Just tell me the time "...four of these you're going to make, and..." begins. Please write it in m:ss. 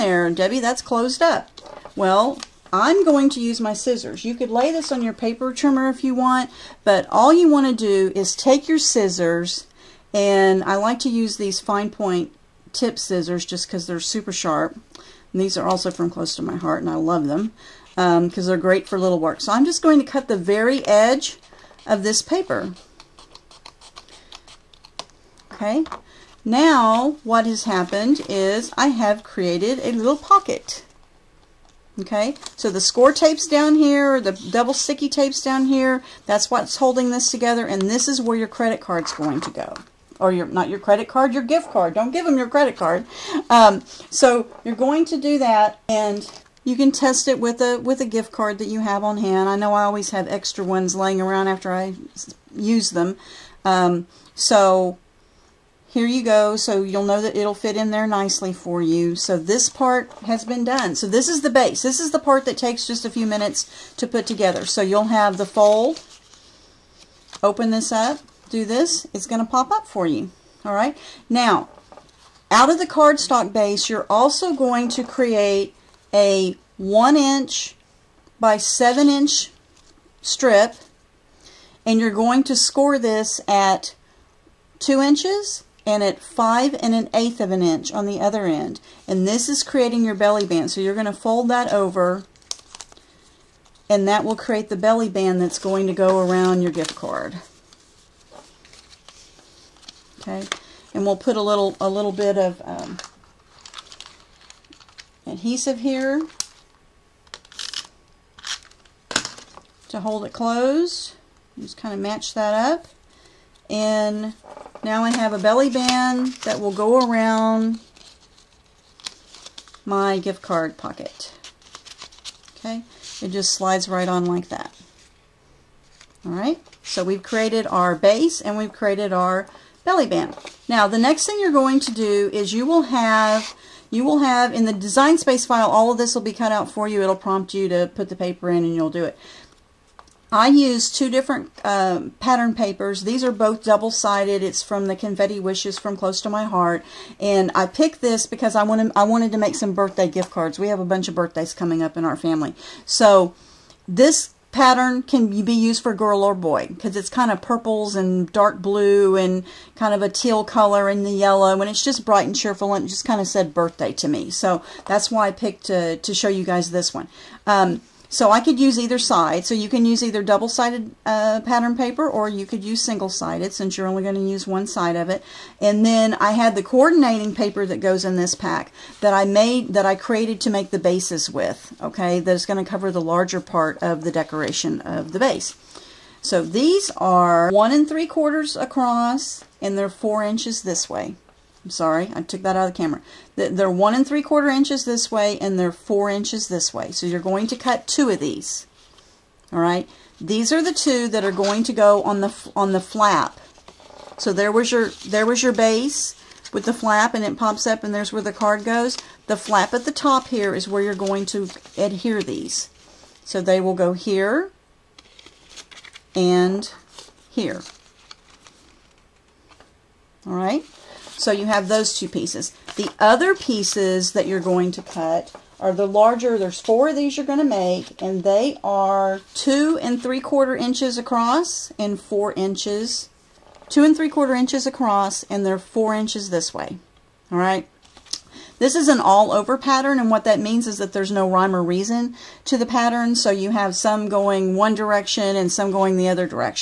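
3:46.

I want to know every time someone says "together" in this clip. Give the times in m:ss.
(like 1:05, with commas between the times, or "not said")
0:37, 1:04.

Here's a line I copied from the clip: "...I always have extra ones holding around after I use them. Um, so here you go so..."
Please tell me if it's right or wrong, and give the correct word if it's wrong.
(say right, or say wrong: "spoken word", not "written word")
wrong: "laying", not "holding".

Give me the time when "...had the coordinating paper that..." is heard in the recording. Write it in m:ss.
2:56.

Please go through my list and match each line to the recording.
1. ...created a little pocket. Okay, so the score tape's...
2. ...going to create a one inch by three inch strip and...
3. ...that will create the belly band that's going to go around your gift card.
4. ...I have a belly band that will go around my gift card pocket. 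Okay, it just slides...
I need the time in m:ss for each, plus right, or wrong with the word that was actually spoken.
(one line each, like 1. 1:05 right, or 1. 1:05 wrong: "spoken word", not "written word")
1. 0:29 right
2. 1:14 wrong: "seven", not "three"
3. 1:34 right
4. 1:55 right.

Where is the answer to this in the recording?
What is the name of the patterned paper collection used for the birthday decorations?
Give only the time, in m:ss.
2:24.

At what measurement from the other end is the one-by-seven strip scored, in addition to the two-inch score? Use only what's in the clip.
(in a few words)
5 1/8 inches.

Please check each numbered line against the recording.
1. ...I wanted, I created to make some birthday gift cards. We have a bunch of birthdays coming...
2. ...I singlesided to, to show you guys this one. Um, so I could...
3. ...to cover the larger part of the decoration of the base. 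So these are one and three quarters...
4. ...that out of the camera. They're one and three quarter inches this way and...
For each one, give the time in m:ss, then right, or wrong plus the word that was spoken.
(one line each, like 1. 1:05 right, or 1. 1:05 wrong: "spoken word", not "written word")
1. 2:28 wrong: "wanted", not "created"
2. 2:45 wrong: "picked", not "singlesided"
3. 3:02 right
4. 3:12 right.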